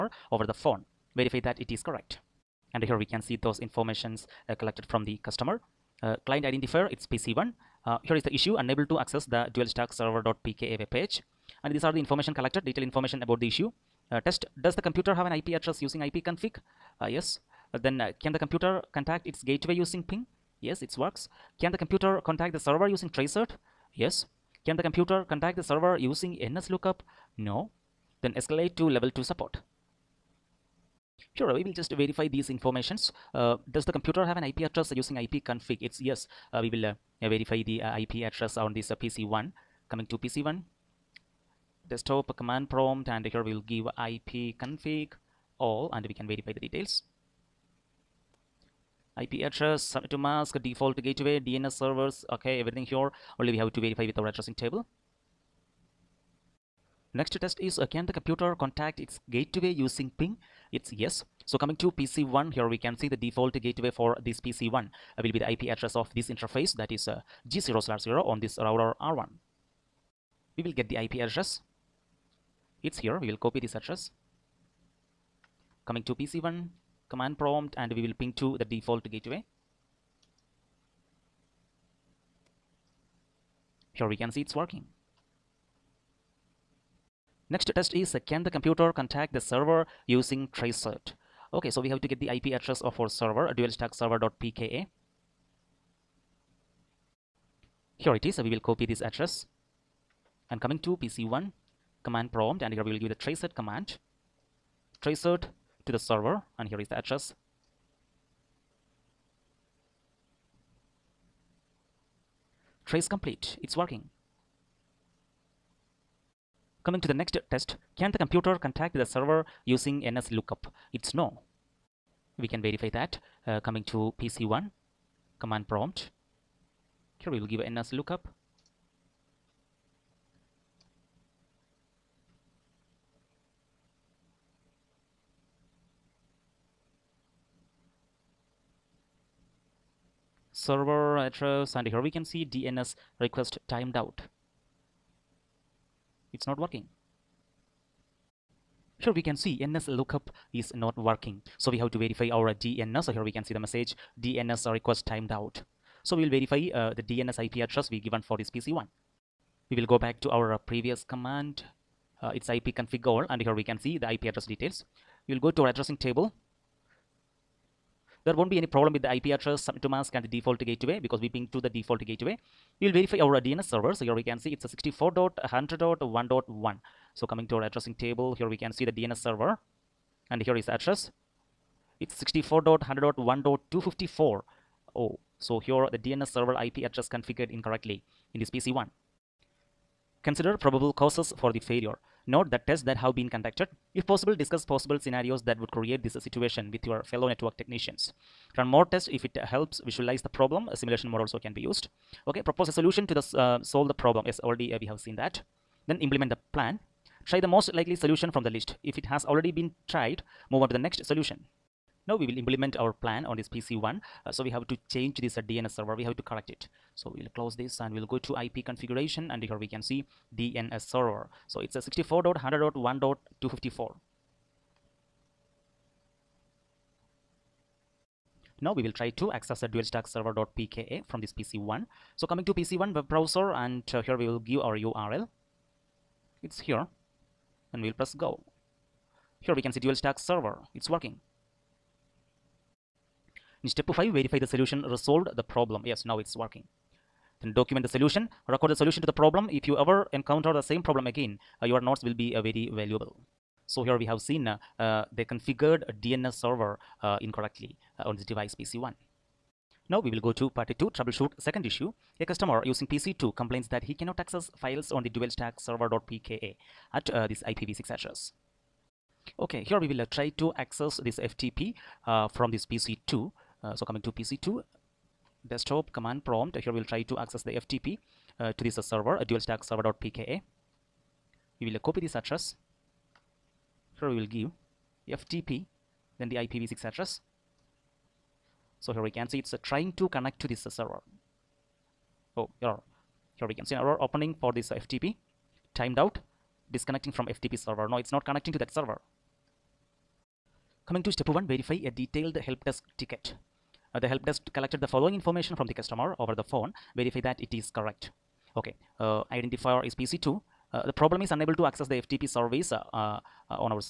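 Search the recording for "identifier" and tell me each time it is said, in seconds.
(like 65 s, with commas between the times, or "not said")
6 s, 309 s.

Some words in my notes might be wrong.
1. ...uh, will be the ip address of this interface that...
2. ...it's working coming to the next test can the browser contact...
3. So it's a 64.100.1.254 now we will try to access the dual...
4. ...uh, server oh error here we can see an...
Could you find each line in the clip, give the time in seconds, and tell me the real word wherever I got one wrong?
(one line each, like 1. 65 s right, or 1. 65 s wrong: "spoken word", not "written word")
1. 65 s right
2. 113 s wrong: "computer", not "browser"
3. 221 s right
4. 290 s right.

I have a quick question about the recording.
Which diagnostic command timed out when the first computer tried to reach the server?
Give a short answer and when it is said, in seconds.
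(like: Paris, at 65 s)
NSLOOKUP, at 26 s.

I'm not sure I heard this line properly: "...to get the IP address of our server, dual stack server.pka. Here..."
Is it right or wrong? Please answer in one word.
right.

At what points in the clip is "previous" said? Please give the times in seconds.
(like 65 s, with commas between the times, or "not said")
160 s.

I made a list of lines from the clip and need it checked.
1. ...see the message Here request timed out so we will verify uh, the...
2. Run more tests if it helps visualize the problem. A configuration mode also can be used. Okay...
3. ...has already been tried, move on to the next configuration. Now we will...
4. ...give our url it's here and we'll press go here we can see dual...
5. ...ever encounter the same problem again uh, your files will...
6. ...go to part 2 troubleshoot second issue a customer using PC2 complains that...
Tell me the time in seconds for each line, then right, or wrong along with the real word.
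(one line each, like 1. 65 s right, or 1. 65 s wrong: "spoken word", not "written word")
1. 153 s wrong: "DNS", not "Here"
2. 198 s wrong: "simulation", not "configuration"
3. 209 s wrong: "solution", not "configuration"
4. 234 s right
5. 249 s wrong: "notes", not "files"
6. 260 s right.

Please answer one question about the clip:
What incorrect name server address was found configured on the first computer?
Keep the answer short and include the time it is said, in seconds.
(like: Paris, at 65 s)
64.100.1.1, at 174 s.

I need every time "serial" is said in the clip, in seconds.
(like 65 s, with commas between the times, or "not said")
not said.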